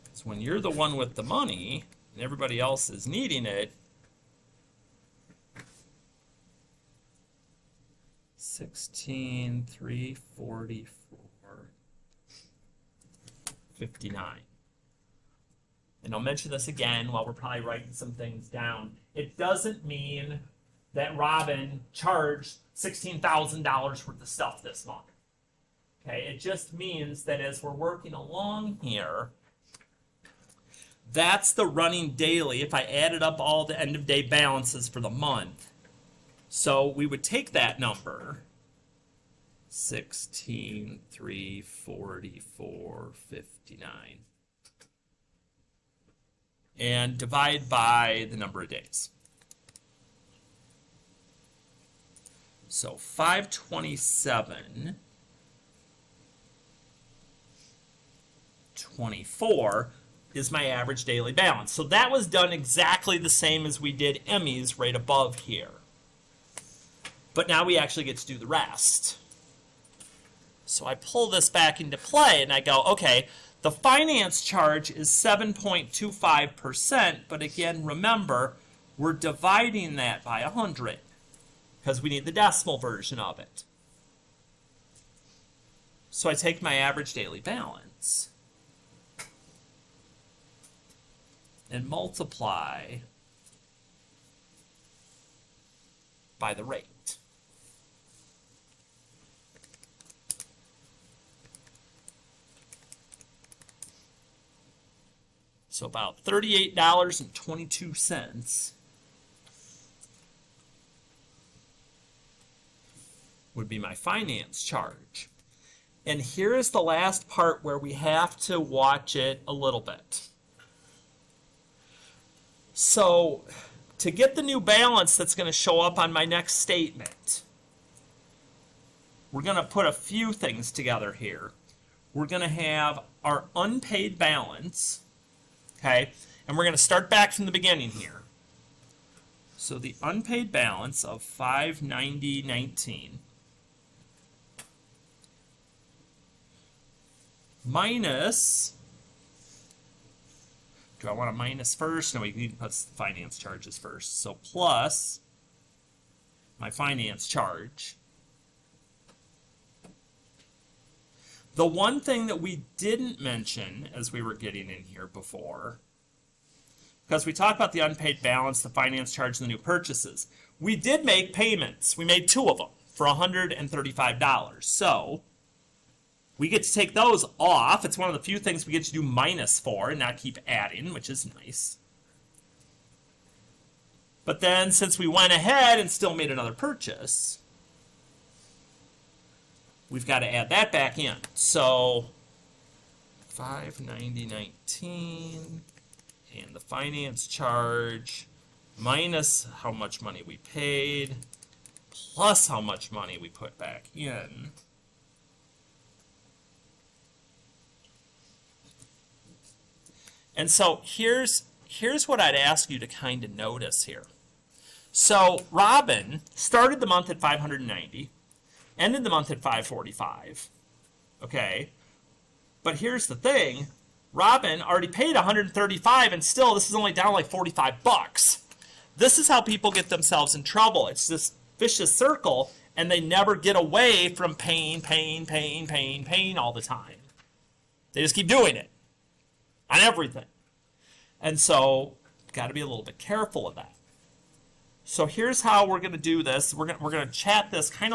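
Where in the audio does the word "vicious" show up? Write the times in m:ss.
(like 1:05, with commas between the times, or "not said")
3:51.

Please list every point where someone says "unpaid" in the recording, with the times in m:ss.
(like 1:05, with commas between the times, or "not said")
2:13, 2:20, 2:47.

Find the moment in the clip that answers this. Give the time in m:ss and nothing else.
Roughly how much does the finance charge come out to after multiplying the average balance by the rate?
1:46.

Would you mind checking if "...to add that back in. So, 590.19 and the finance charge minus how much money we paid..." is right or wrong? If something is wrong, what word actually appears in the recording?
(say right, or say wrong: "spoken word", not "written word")
right.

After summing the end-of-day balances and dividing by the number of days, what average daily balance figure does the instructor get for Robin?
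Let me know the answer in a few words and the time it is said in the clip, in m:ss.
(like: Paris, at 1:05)
527.24, at 0:52.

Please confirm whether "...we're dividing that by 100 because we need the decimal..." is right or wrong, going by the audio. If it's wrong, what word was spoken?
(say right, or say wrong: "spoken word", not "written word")
right.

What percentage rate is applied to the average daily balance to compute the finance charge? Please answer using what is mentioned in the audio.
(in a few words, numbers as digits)
7.25%.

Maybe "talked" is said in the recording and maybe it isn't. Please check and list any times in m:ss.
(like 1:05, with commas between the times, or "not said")
2:47.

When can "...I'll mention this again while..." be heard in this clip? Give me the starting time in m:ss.
0:16.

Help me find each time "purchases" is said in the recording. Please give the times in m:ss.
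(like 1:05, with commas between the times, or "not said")
2:49, 3:06.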